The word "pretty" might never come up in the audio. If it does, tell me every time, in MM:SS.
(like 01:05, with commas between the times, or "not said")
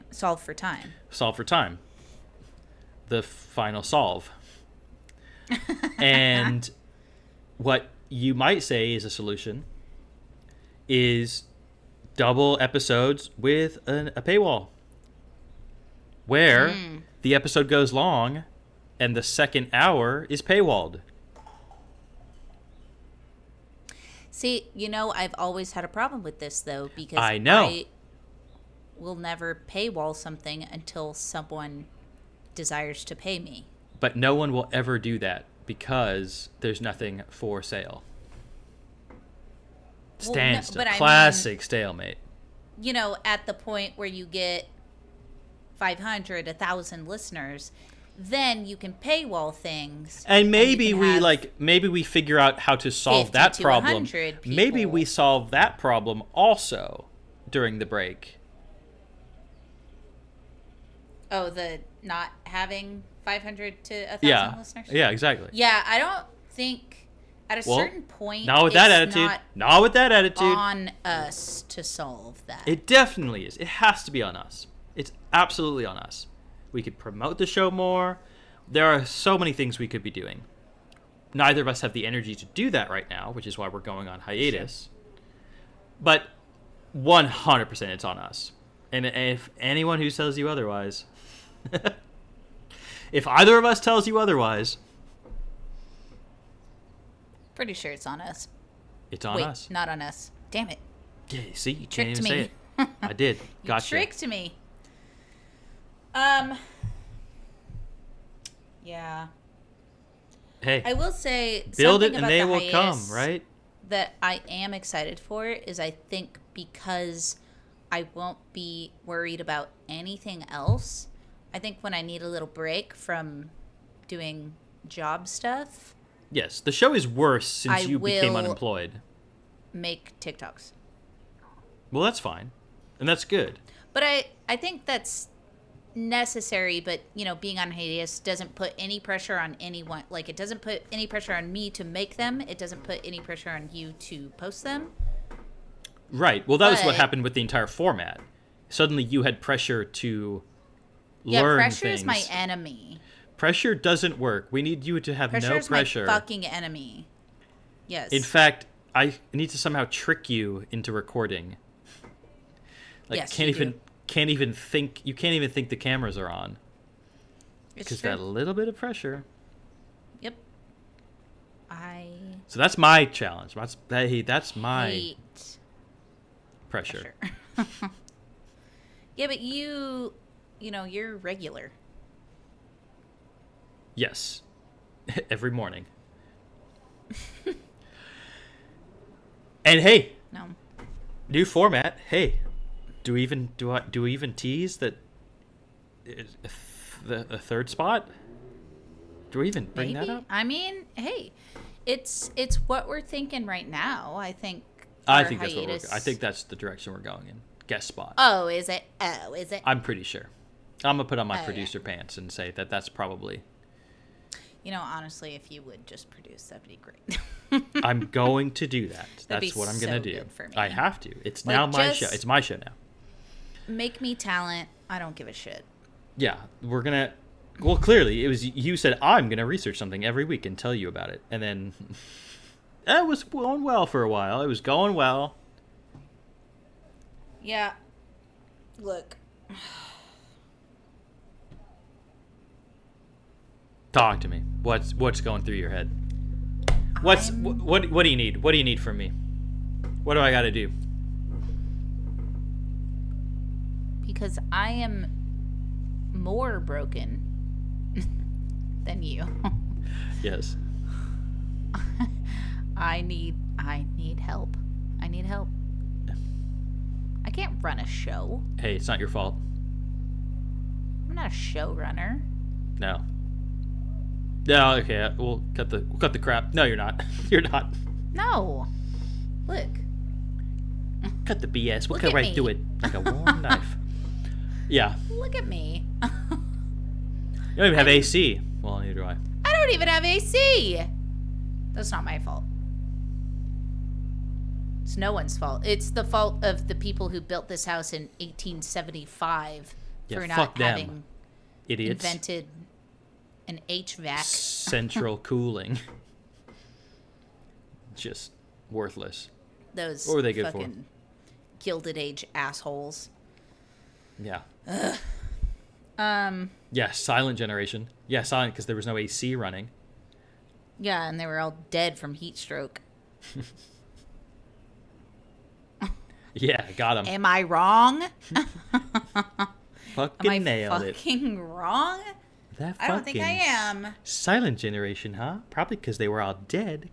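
01:37, 03:29.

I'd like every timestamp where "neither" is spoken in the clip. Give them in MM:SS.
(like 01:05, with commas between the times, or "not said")
01:21, 04:48.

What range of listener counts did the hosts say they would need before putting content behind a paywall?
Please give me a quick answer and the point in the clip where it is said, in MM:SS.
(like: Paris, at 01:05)
500 to 1,000, at 00:45.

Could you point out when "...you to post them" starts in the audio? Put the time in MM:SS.
02:23.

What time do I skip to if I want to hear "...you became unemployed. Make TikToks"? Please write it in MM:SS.
02:07.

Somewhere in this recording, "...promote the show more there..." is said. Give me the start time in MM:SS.
01:16.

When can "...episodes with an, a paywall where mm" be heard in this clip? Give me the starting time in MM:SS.
00:12.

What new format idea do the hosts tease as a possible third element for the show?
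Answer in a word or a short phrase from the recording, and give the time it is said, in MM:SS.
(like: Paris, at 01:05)
Guest spot, at 03:27.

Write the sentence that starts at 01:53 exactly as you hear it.
That I am excited for is I think because I won't be worried about anything else.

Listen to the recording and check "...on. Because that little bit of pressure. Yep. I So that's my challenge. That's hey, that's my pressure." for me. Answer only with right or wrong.
right.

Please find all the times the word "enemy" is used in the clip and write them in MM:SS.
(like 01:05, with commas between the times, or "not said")
02:32, 02:36.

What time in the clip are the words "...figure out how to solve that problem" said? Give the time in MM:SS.
00:52.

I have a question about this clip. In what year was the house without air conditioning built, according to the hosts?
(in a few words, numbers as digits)
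1875.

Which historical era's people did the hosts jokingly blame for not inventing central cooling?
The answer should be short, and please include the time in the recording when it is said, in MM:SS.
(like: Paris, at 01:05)
Gilded Age, at 05:11.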